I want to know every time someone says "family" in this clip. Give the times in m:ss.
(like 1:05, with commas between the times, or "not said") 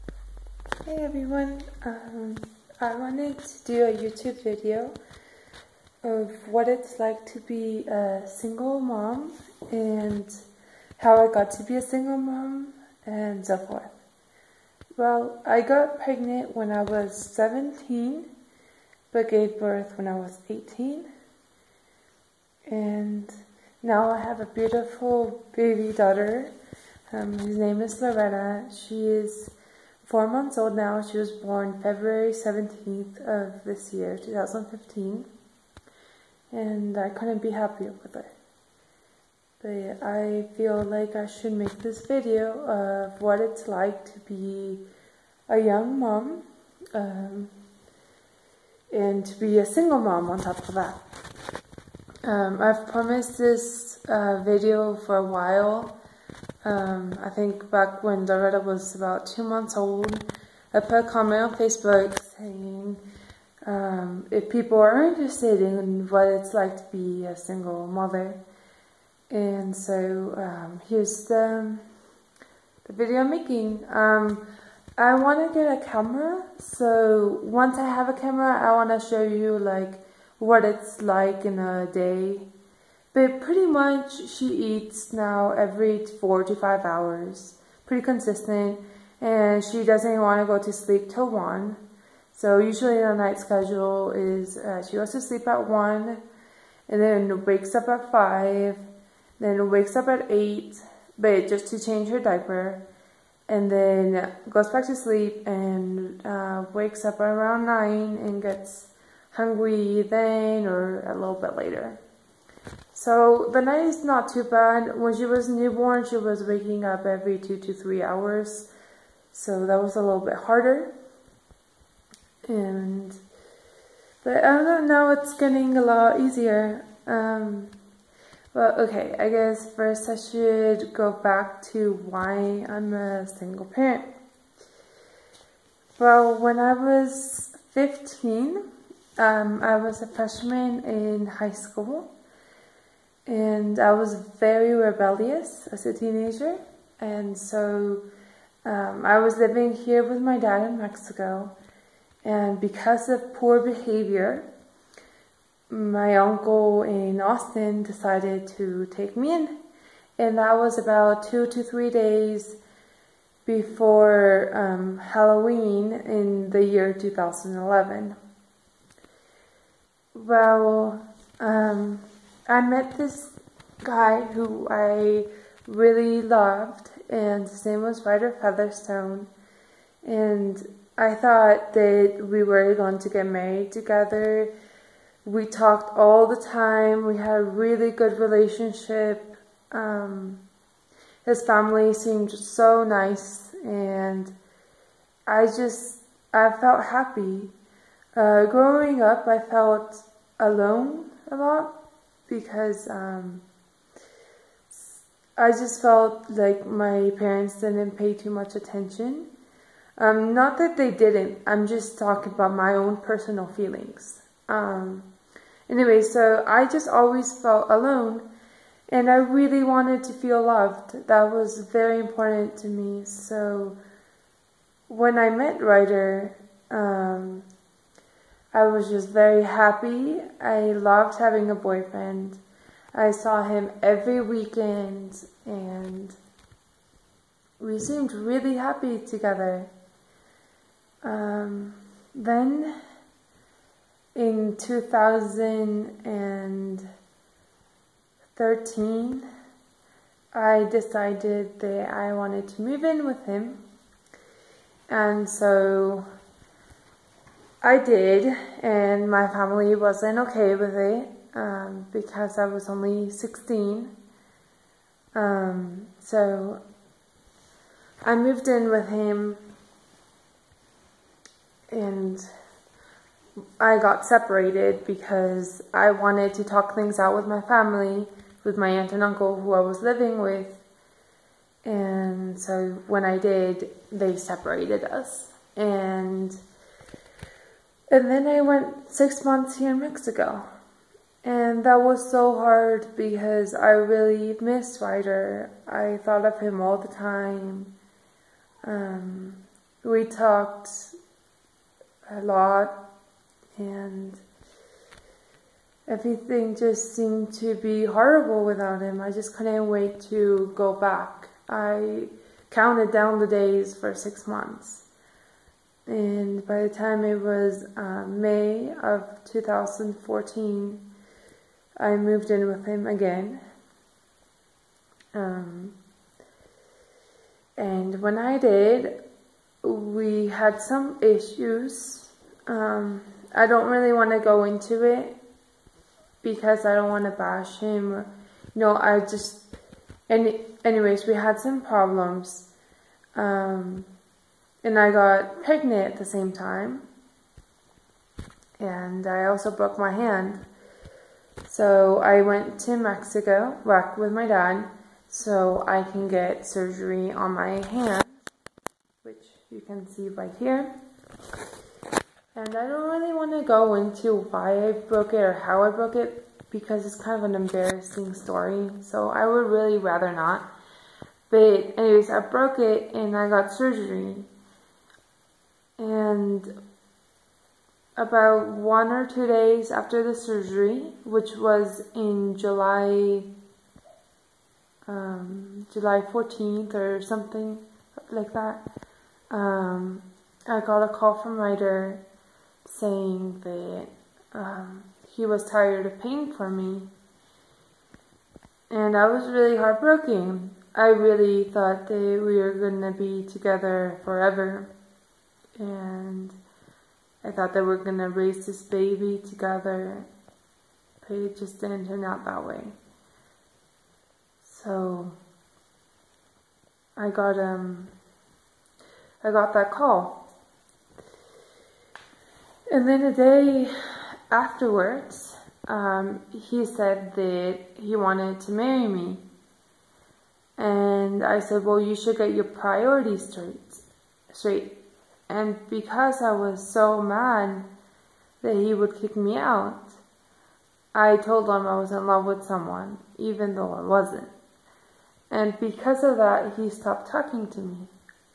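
3:11, 4:19, 4:37.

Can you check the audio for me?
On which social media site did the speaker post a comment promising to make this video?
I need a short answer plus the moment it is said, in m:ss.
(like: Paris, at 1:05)
Facebook, at 1:01.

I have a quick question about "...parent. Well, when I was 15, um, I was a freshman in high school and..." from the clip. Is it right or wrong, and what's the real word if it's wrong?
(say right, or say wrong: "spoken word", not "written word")
right.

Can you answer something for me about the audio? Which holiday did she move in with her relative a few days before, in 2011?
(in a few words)
Halloween.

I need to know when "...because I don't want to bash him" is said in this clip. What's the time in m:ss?
5:36.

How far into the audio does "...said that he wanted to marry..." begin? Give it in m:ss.
7:06.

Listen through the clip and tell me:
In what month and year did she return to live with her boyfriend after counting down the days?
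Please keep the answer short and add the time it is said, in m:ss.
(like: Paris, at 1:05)
May 2014, at 5:18.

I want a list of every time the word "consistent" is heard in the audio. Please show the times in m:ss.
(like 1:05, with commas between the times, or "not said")
1:28.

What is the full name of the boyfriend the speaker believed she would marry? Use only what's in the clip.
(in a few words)
Ryder Featherstone.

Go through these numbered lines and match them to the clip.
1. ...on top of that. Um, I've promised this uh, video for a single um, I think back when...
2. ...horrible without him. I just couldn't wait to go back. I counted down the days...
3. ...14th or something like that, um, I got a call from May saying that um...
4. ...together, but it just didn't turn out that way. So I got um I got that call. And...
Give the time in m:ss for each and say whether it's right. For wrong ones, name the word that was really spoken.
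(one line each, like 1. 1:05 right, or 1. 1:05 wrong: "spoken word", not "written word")
1. 0:50 wrong: "while", not "single"
2. 5:07 right
3. 6:26 wrong: "Ryder", not "May"
4. 6:49 right.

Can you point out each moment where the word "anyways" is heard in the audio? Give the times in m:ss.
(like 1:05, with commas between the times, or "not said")
3:35, 5:40, 6:11.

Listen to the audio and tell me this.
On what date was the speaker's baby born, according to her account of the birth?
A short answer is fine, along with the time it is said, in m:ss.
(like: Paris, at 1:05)
February 17, at 0:31.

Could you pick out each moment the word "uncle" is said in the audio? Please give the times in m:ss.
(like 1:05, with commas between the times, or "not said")
2:36, 4:39.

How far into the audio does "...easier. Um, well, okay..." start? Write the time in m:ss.
2:06.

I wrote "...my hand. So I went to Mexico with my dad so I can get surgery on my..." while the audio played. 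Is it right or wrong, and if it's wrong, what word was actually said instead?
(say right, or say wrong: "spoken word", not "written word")
right.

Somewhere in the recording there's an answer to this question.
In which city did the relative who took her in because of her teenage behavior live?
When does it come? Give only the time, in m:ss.
2:37.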